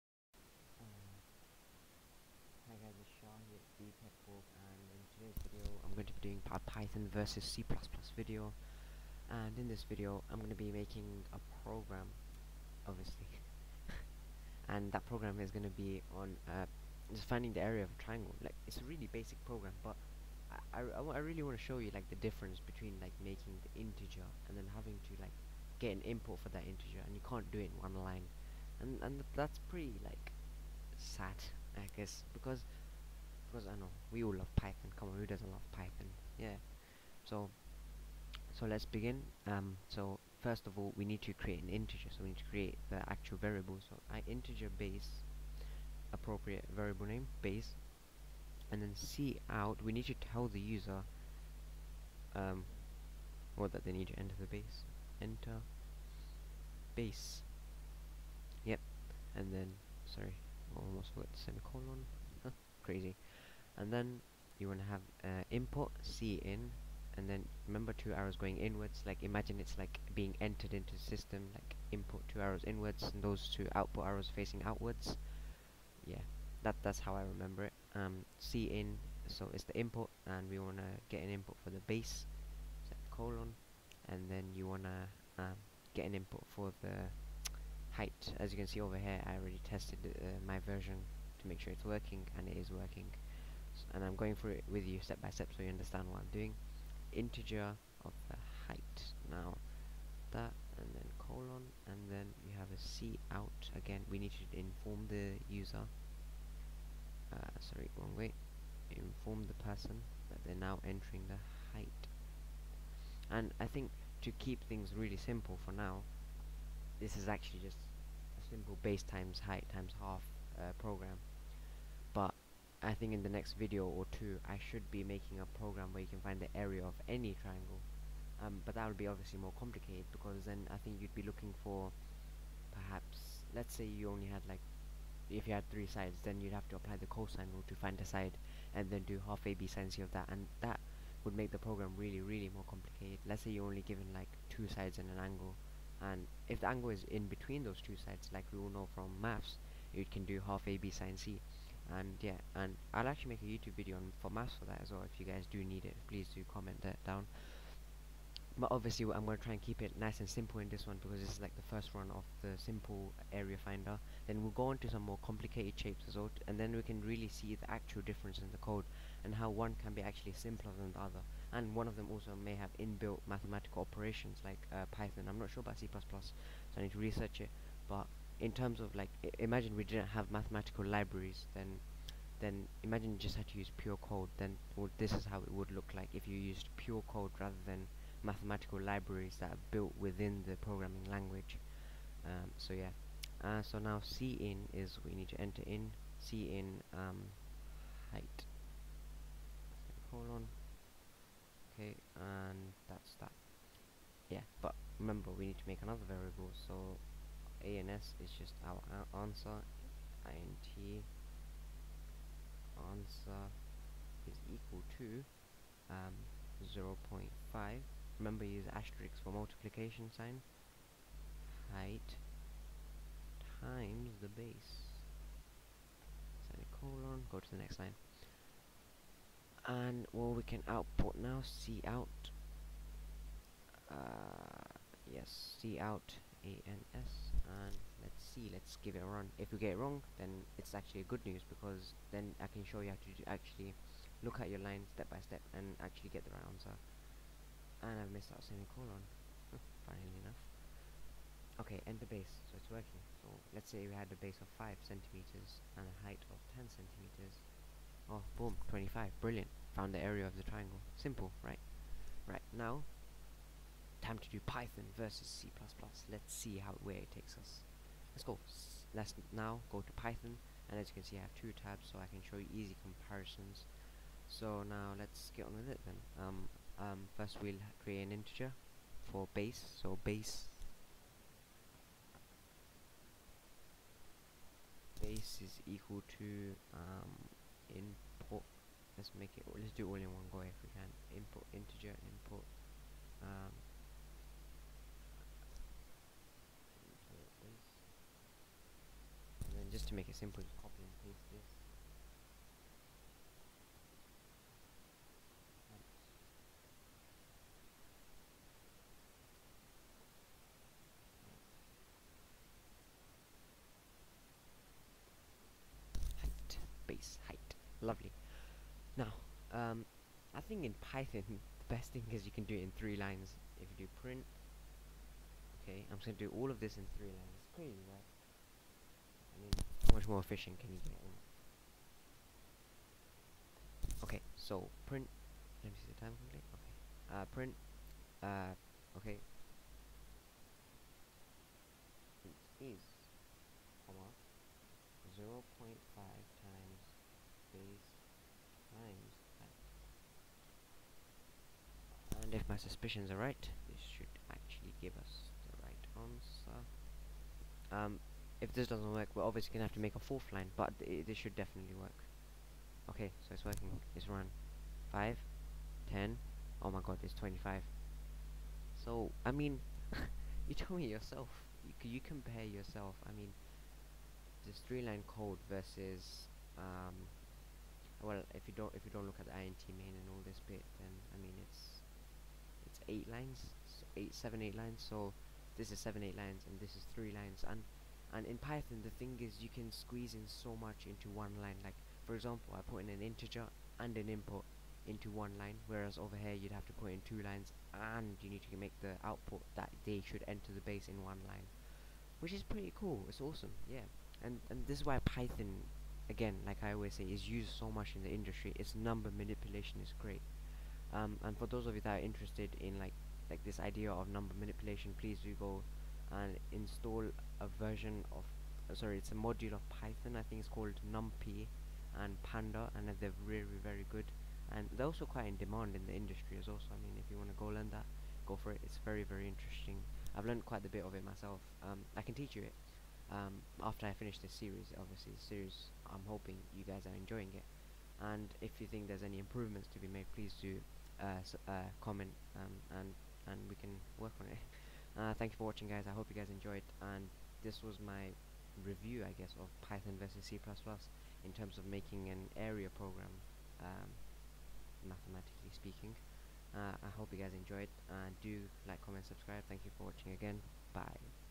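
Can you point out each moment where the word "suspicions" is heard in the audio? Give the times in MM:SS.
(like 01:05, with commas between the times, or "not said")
05:52.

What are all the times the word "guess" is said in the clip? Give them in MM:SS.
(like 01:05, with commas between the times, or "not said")
00:31, 07:29.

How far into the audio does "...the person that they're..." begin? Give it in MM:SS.
01:49.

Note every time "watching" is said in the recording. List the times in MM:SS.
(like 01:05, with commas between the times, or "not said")
07:25, 07:39.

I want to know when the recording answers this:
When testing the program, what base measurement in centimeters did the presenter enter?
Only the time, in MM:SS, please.
04:14.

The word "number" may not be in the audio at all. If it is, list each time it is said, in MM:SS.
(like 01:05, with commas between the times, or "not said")
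06:48, 06:54.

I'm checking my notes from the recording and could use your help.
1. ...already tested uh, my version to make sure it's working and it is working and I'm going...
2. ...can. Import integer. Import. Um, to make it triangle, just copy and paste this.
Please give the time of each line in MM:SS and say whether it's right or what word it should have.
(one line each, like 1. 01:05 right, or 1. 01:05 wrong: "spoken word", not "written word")
1. 01:29 right
2. 04:50 wrong: "simple", not "triangle".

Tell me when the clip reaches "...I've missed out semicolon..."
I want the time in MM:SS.
04:07.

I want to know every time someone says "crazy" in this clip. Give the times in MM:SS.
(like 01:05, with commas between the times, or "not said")
01:02, 05:27.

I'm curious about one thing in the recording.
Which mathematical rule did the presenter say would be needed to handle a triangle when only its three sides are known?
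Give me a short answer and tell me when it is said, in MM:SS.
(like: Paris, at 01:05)
cosine rule, at 02:17.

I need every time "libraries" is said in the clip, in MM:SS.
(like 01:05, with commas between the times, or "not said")
03:00, 03:08.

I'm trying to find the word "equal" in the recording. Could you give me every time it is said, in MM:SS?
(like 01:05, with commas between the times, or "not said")
03:34, 04:45.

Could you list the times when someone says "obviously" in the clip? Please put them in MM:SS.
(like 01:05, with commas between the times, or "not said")
00:12, 02:09, 02:38, 05:59, 07:14.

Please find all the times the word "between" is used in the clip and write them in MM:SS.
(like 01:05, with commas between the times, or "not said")
00:22, 02:27.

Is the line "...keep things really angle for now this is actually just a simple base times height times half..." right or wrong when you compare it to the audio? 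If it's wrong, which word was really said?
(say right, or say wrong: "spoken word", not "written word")
wrong: "simple", not "angle".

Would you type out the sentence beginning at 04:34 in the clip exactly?
So now let's get on with it then.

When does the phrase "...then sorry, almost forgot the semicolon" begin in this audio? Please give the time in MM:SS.
00:59.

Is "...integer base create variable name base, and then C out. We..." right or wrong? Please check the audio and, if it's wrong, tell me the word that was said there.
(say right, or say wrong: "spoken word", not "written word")
wrong: "appropriate", not "create".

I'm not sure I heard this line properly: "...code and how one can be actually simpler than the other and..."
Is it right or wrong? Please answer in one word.
right.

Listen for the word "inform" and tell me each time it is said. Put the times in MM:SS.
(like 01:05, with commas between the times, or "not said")
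01:44, 01:48.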